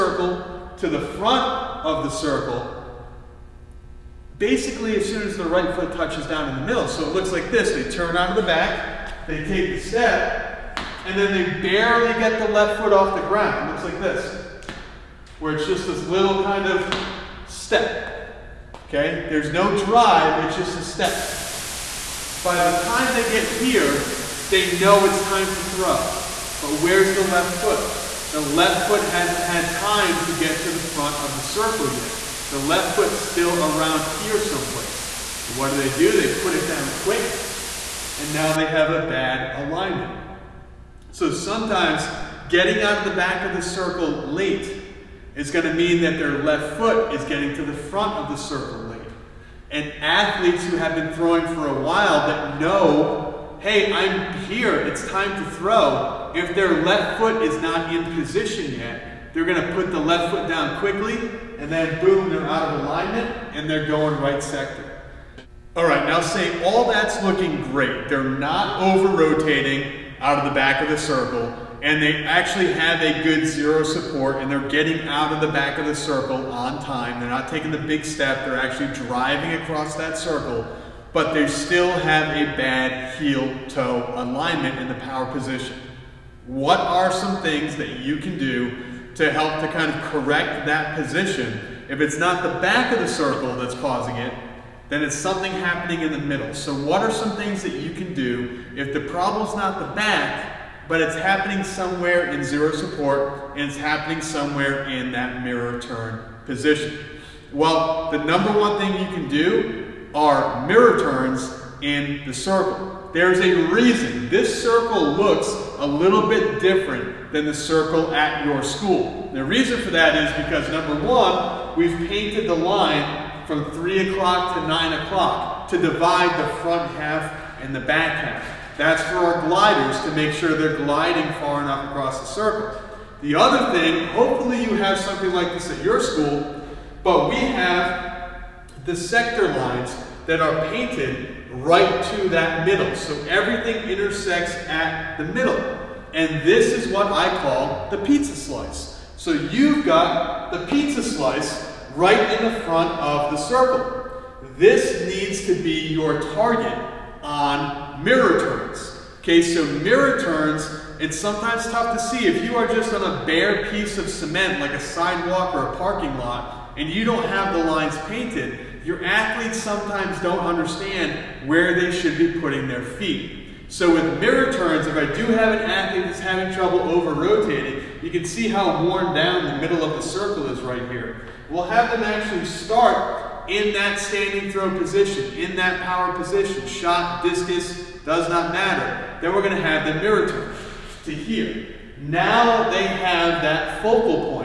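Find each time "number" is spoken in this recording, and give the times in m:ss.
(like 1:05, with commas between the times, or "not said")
1:48, 2:00.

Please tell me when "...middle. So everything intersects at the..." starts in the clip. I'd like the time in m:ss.
2:22.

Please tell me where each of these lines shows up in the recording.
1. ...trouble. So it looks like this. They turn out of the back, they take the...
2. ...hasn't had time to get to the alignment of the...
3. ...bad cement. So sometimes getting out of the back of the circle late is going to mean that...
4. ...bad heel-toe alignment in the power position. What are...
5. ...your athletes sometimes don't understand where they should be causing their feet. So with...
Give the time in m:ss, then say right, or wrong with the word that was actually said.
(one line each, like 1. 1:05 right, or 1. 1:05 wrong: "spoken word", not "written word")
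1. 0:06 wrong: "middle", not "trouble"
2. 0:29 wrong: "front", not "alignment"
3. 0:39 wrong: "alignment", not "cement"
4. 1:22 right
5. 2:48 wrong: "putting", not "causing".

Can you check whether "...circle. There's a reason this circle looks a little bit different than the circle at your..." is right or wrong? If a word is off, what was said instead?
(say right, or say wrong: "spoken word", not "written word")
right.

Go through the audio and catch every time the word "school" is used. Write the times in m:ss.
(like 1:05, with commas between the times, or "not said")
1:58, 2:16.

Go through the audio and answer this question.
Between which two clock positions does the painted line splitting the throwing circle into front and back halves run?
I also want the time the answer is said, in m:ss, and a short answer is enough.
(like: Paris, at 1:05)
3 o'clock to 9 o'clock, at 2:03.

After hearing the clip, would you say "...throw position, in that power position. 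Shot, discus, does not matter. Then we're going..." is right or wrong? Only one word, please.
right.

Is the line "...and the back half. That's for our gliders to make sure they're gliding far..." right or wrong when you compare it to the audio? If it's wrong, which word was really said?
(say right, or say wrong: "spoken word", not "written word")
right.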